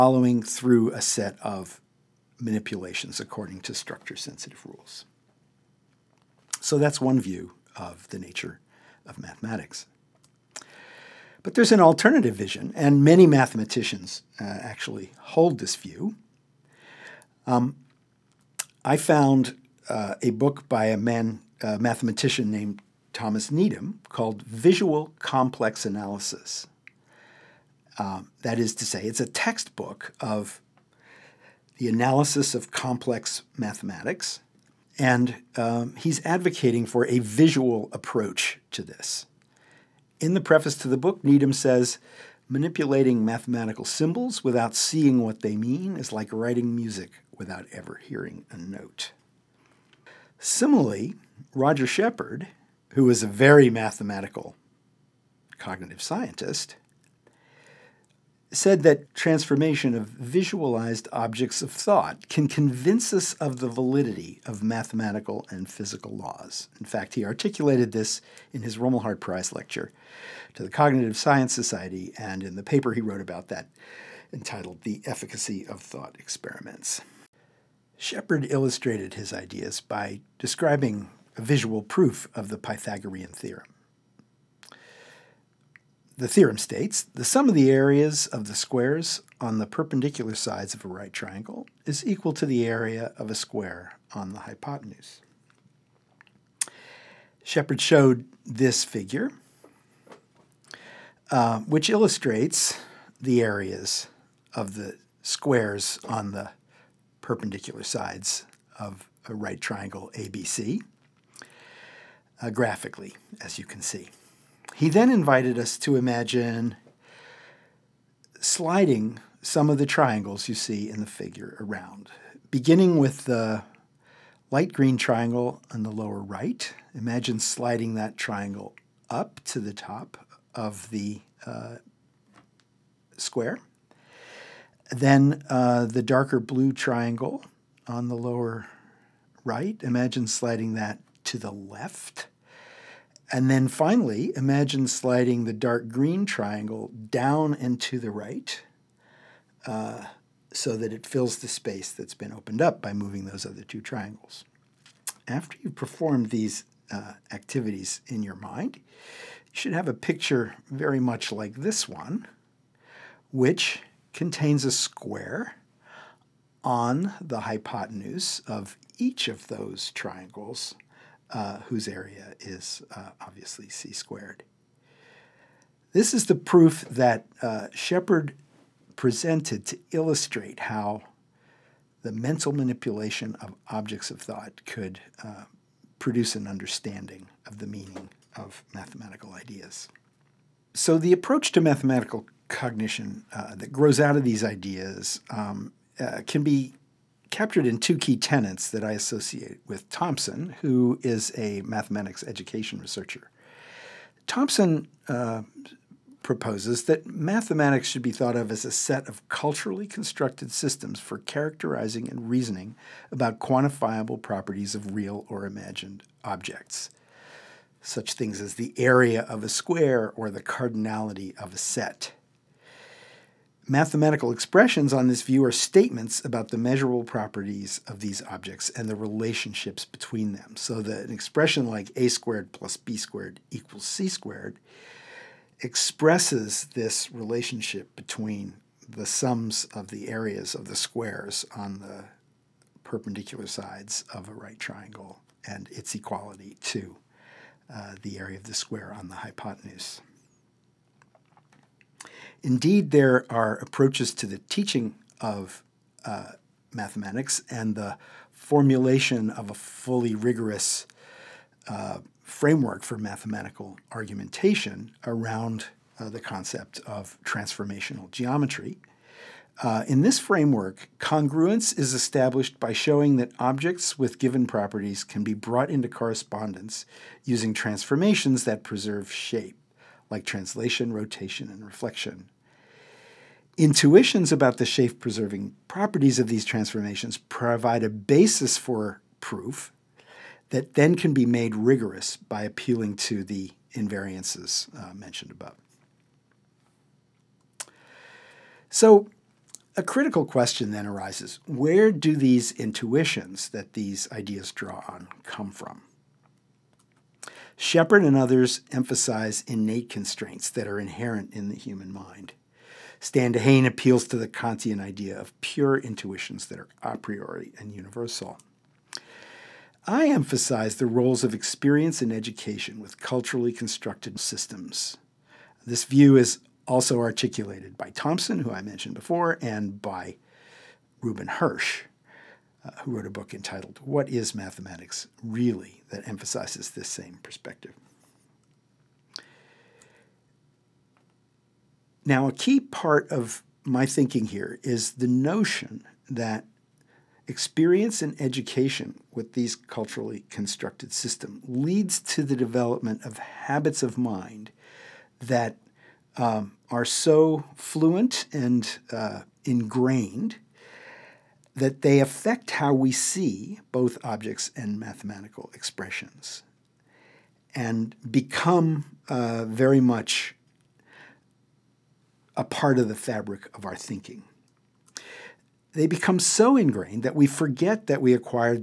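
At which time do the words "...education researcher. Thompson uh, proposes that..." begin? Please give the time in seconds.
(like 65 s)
202 s.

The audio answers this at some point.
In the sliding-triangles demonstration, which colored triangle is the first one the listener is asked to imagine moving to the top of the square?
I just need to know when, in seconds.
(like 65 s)
124 s.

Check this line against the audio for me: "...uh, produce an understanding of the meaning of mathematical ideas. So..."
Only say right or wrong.
right.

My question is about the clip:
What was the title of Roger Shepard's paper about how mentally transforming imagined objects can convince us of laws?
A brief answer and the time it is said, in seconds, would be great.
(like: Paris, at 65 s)
The Efficacy of Thought Experiments, at 74 s.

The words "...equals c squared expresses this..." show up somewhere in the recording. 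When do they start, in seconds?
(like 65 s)
233 s.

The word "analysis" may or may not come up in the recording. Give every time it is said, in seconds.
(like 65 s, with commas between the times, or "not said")
25 s, 31 s.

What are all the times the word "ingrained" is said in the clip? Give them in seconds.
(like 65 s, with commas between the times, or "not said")
359 s, 376 s.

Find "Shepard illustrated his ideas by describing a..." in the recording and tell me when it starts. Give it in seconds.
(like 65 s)
77 s.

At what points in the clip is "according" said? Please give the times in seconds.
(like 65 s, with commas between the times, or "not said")
3 s.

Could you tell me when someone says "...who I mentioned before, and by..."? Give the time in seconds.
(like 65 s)
328 s.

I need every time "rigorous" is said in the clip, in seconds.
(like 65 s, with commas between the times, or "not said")
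260 s, 291 s.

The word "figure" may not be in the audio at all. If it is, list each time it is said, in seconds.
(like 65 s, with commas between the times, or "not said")
98 s, 121 s.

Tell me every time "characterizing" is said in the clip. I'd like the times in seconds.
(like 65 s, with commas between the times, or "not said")
211 s.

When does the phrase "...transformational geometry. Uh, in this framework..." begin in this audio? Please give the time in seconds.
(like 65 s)
267 s.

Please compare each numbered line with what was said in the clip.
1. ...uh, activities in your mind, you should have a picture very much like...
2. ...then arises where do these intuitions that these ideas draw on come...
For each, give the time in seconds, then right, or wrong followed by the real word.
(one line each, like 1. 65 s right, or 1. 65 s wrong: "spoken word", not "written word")
1. 156 s right
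2. 300 s right.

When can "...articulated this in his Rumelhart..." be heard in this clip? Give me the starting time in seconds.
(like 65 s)
67 s.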